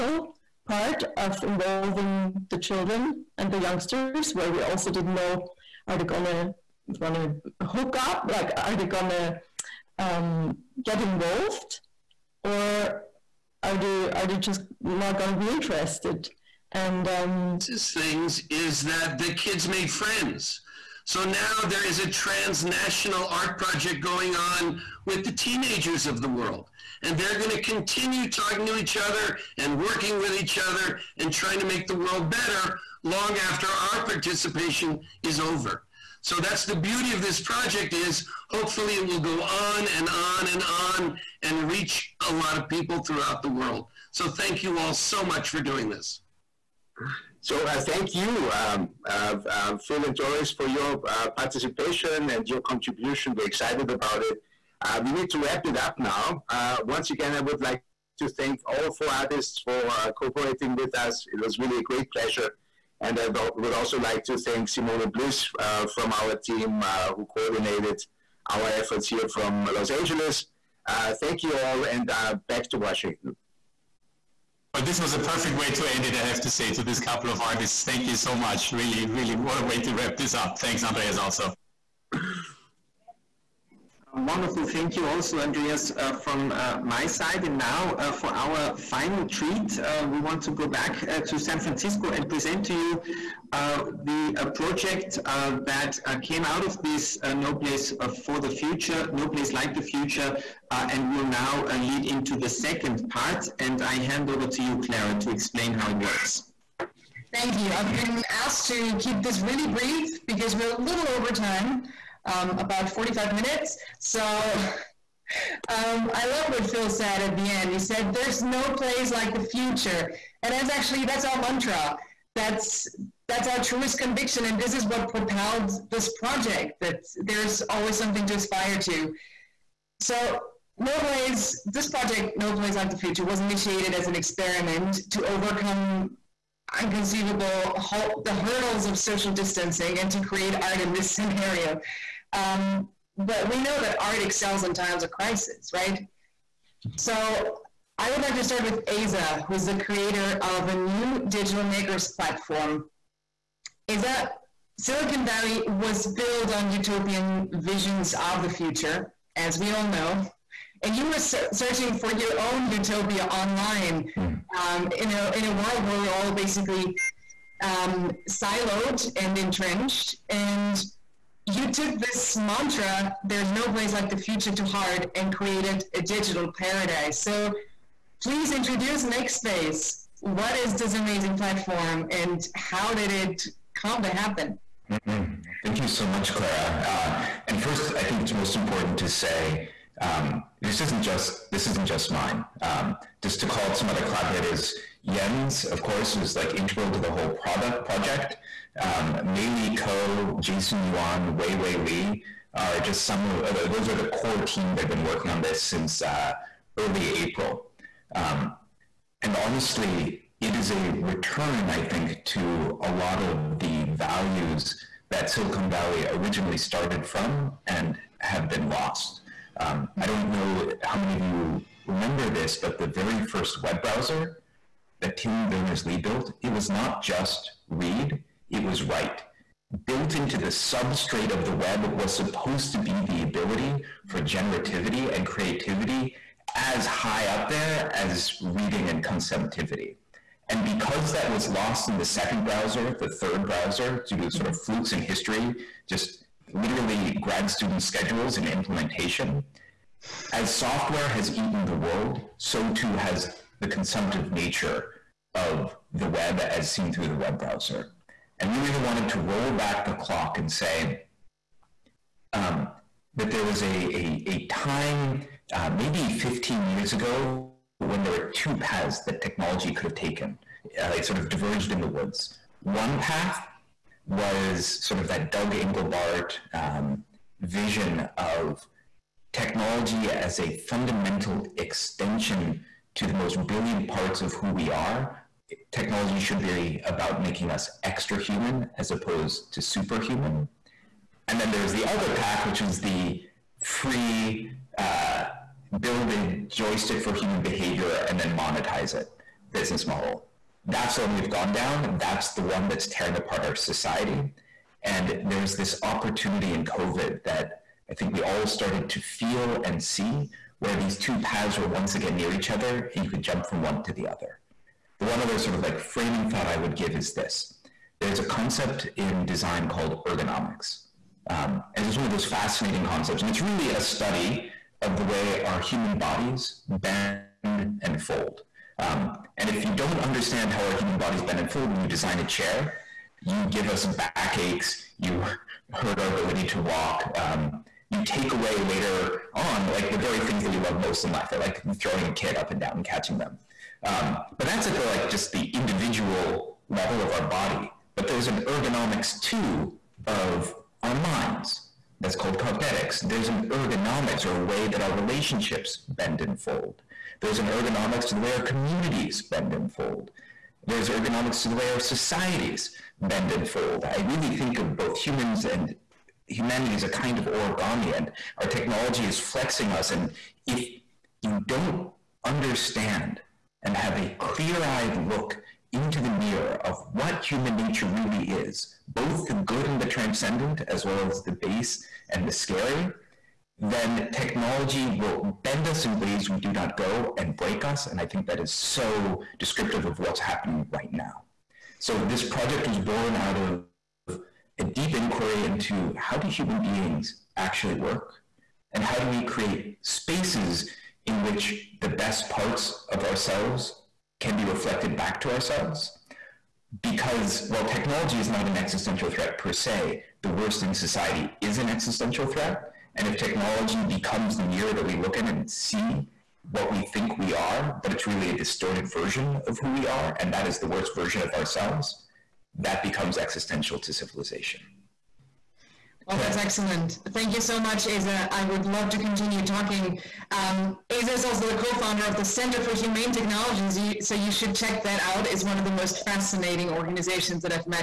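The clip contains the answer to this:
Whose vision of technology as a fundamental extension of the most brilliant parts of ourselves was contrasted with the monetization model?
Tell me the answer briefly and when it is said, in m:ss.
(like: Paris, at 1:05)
Doug Engelbart, at 4:35.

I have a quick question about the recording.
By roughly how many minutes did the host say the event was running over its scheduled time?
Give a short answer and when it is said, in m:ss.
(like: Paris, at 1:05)
45 minutes, at 1:52.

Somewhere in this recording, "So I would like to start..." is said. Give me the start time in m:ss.
2:26.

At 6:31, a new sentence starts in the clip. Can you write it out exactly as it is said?
So this project was born out of a deep inquiry into how do human beings actually work?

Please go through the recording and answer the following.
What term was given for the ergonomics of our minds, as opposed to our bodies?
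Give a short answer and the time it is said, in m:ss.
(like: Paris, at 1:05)
cognetics, at 5:52.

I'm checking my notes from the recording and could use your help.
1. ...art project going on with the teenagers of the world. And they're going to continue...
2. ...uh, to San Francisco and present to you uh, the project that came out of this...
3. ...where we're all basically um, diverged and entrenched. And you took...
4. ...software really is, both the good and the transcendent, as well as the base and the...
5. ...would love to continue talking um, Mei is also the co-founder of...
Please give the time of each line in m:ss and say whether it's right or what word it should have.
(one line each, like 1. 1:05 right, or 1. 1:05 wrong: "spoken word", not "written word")
1. 0:23 right
2. 1:31 right
3. 2:45 wrong: "siloed", not "diverged"
4. 6:17 wrong: "nature", not "software"
5. 7:08 wrong: "Aza", not "Mei".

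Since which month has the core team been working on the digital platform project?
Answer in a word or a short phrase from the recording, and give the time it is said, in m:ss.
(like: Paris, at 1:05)
April, at 3:26.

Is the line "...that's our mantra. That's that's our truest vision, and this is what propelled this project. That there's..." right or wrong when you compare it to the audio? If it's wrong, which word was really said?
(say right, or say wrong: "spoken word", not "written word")
wrong: "conviction", not "vision".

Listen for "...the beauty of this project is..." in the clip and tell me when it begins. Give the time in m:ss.
0:36.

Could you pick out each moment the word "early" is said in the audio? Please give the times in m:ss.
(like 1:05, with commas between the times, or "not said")
3:26.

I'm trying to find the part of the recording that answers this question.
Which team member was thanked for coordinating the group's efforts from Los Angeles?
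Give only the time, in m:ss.
1:04.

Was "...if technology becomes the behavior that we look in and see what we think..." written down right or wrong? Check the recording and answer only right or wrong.
wrong.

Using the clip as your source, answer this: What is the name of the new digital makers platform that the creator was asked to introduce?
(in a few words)
MakeSpace.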